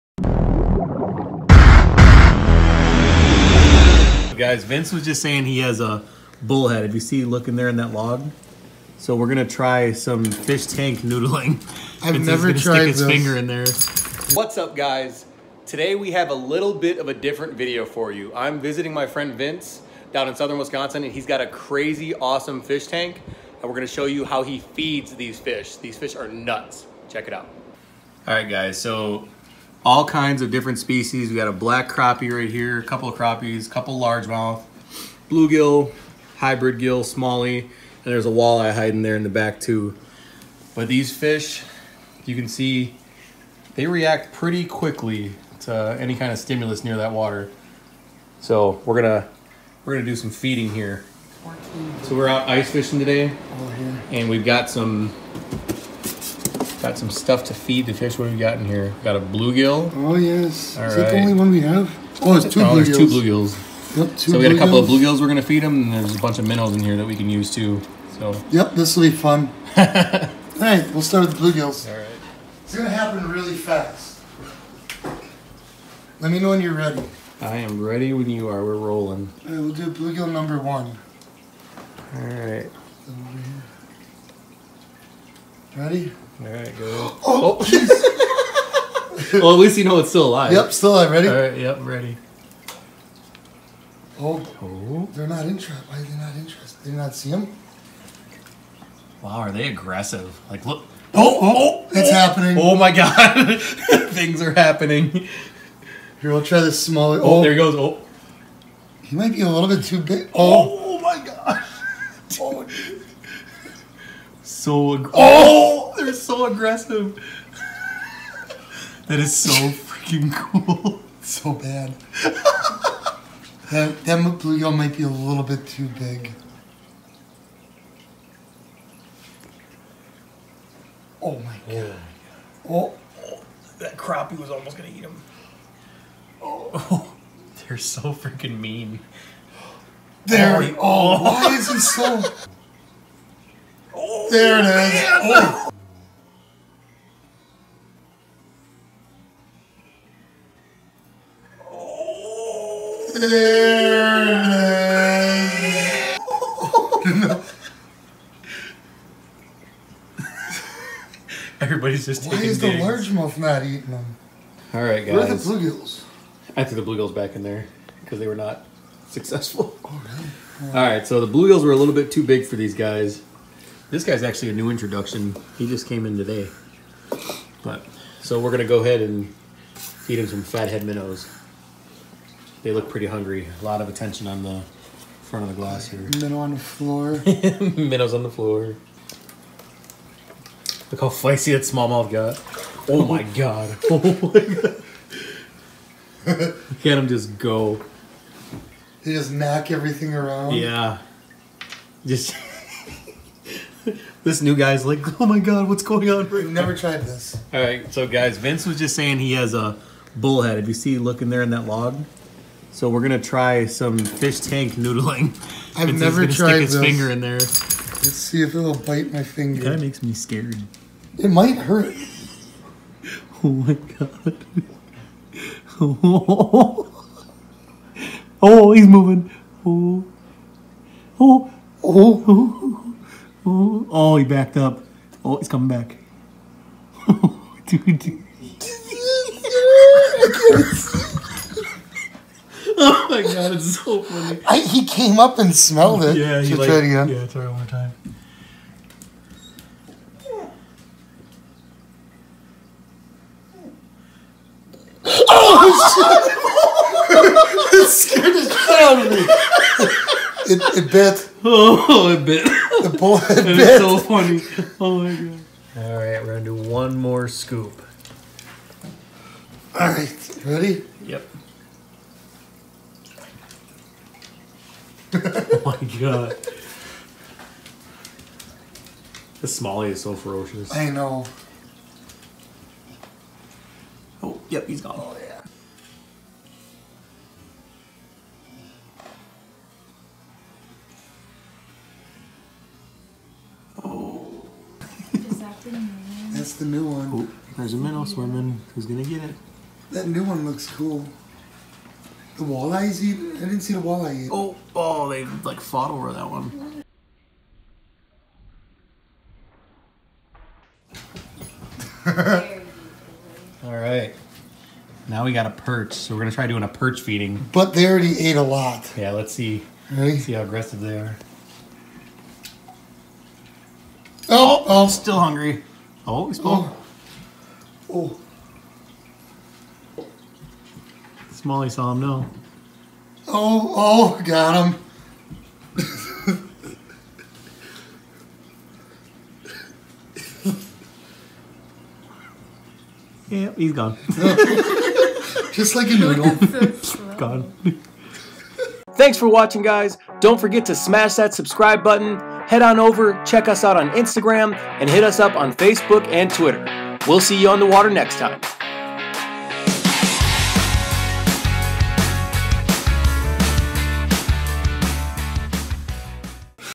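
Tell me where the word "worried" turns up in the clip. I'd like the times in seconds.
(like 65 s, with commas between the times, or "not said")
not said.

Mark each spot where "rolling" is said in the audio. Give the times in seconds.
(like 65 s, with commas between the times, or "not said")
78 s.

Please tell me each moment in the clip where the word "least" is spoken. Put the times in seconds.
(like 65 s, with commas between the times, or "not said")
89 s.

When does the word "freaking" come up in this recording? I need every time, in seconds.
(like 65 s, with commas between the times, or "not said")
119 s, 138 s.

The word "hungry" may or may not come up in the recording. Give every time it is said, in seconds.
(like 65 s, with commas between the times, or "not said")
183 s, 325 s.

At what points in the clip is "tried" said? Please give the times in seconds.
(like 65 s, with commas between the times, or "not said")
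12 s, 206 s, 216 s.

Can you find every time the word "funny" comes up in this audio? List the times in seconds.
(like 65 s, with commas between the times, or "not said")
244 s, 263 s.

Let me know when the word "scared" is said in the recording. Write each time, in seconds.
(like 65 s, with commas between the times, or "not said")
220 s, 257 s.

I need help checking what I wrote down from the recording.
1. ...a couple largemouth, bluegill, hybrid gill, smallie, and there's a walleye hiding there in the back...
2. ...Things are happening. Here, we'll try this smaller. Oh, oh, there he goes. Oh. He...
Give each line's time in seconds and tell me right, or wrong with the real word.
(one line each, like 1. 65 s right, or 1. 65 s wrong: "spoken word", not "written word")
1. 33 s right
2. 104 s right.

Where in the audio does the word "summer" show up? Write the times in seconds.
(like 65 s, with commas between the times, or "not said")
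not said.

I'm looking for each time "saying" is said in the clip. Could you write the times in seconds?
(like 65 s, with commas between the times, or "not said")
5 s, 208 s.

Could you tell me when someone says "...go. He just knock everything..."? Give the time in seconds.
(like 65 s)
197 s.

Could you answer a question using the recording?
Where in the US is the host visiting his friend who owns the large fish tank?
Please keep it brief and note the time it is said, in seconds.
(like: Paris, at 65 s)
Southern Wisconsin, at 20 s.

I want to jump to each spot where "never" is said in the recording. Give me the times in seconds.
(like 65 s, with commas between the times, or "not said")
12 s, 206 s, 215 s.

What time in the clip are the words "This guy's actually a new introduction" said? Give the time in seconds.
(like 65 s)
173 s.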